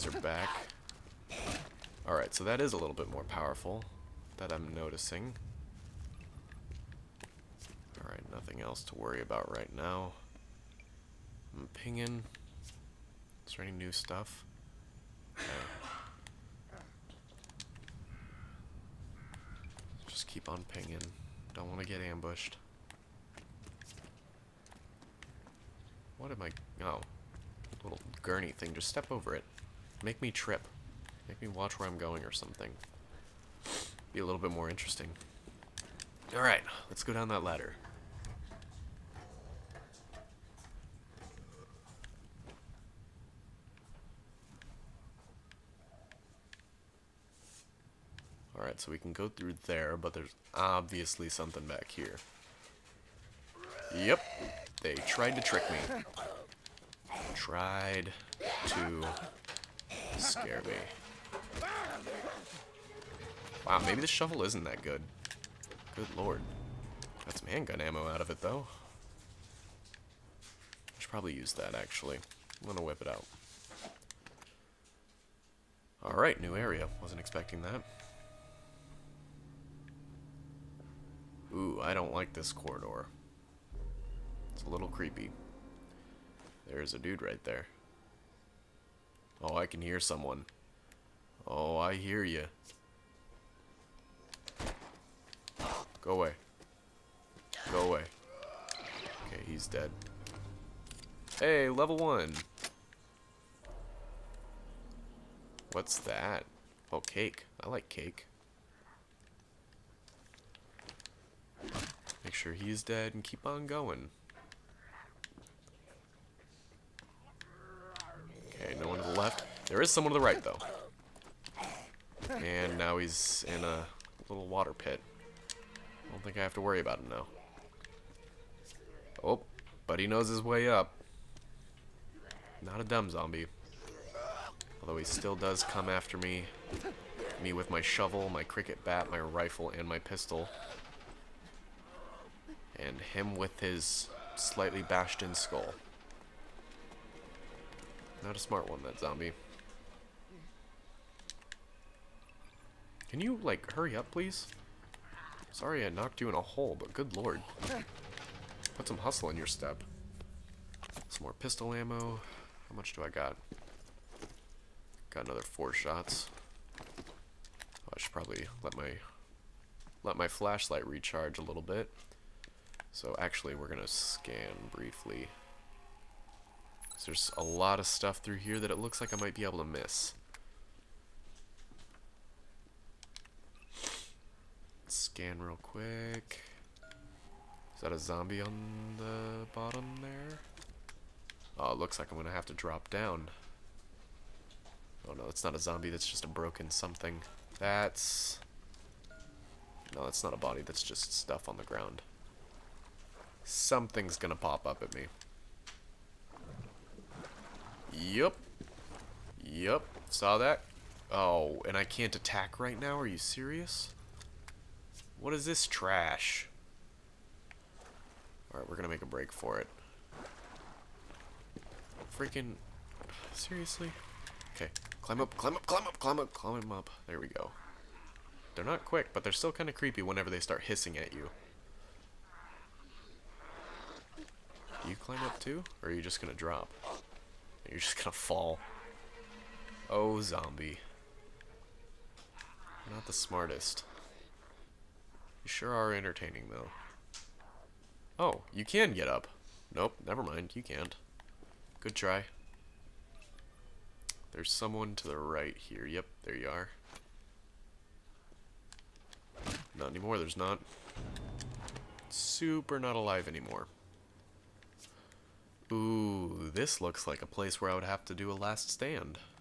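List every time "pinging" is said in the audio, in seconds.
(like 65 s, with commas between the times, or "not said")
11 s, 20 s.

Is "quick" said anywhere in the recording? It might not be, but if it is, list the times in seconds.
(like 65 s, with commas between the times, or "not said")
185 s, 228 s.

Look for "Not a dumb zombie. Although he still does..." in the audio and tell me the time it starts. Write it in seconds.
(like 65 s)
132 s.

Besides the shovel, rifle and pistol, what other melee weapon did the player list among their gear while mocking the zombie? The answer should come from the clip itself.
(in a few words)
Cricket bat.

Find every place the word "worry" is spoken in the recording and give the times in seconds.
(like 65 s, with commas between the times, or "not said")
8 s, 126 s.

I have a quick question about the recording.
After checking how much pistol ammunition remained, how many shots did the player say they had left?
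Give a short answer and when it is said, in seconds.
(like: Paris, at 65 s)
4, at 165 s.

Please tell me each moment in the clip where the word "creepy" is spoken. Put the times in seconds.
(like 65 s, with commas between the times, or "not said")
84 s, 229 s.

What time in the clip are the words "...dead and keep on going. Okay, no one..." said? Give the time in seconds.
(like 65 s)
112 s.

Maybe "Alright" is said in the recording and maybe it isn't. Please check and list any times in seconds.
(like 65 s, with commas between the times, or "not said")
2 s, 8 s, 36 s, 76 s, 218 s.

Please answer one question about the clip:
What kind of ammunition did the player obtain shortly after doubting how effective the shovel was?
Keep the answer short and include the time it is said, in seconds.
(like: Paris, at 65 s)
Handgun ammo, at 67 s.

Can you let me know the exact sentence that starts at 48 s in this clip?
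so we can go through there, but there's obviously something back here.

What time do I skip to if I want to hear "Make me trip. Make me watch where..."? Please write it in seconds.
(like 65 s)
30 s.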